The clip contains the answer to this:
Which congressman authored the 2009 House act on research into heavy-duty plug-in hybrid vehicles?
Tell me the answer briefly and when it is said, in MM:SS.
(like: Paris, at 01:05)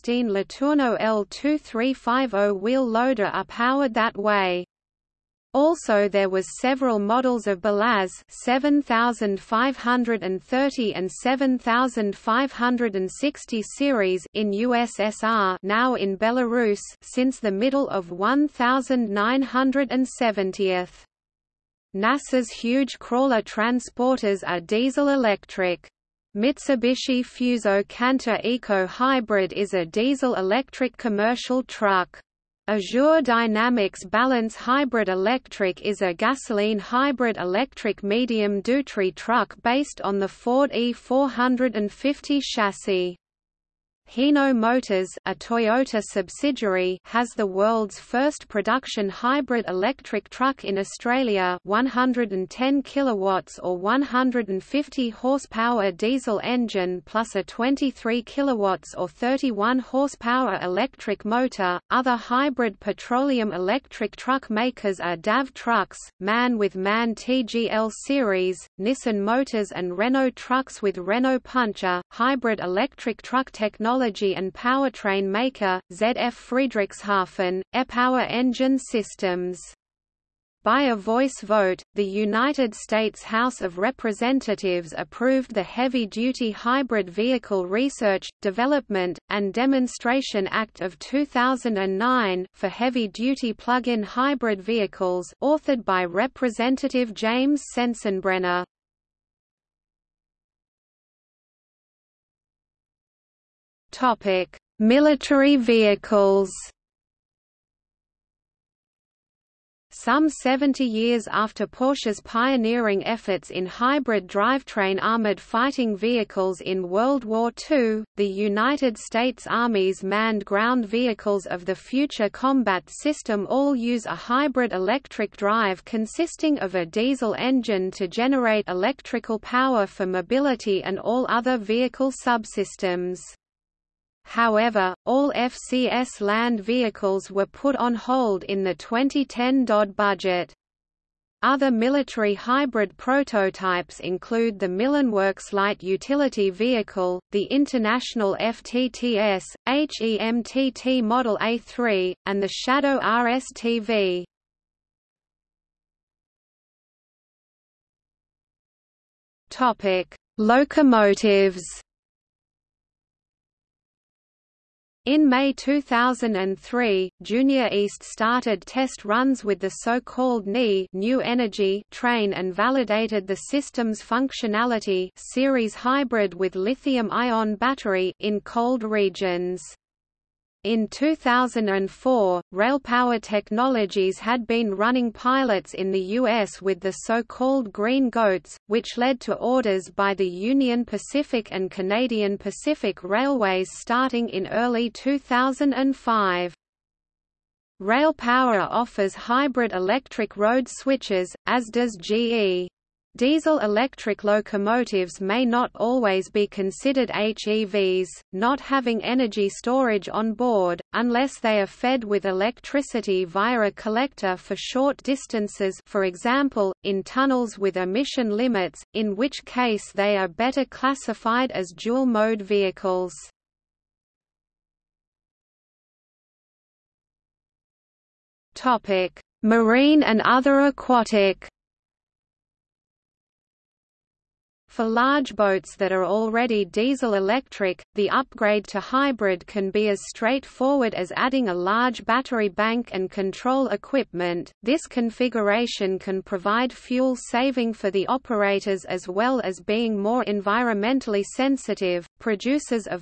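James Sensenbrenner, at 01:37.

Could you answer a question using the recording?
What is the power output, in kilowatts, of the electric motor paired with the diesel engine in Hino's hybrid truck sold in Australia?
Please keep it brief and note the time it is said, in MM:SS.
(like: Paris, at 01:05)
23 kilowatts, at 00:57.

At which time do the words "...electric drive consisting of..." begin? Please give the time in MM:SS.
02:04.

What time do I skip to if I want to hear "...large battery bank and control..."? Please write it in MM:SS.
04:01.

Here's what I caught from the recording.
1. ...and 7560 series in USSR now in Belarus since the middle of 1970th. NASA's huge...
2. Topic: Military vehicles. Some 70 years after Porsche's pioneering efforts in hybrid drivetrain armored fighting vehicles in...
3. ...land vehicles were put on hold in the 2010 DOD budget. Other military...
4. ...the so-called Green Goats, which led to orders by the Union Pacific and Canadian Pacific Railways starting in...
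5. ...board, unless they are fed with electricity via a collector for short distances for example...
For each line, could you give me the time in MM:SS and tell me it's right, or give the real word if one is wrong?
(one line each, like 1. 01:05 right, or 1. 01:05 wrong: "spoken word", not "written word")
1. 00:10 right
2. 01:43 right
3. 02:16 right
4. 03:06 right
5. 03:30 right.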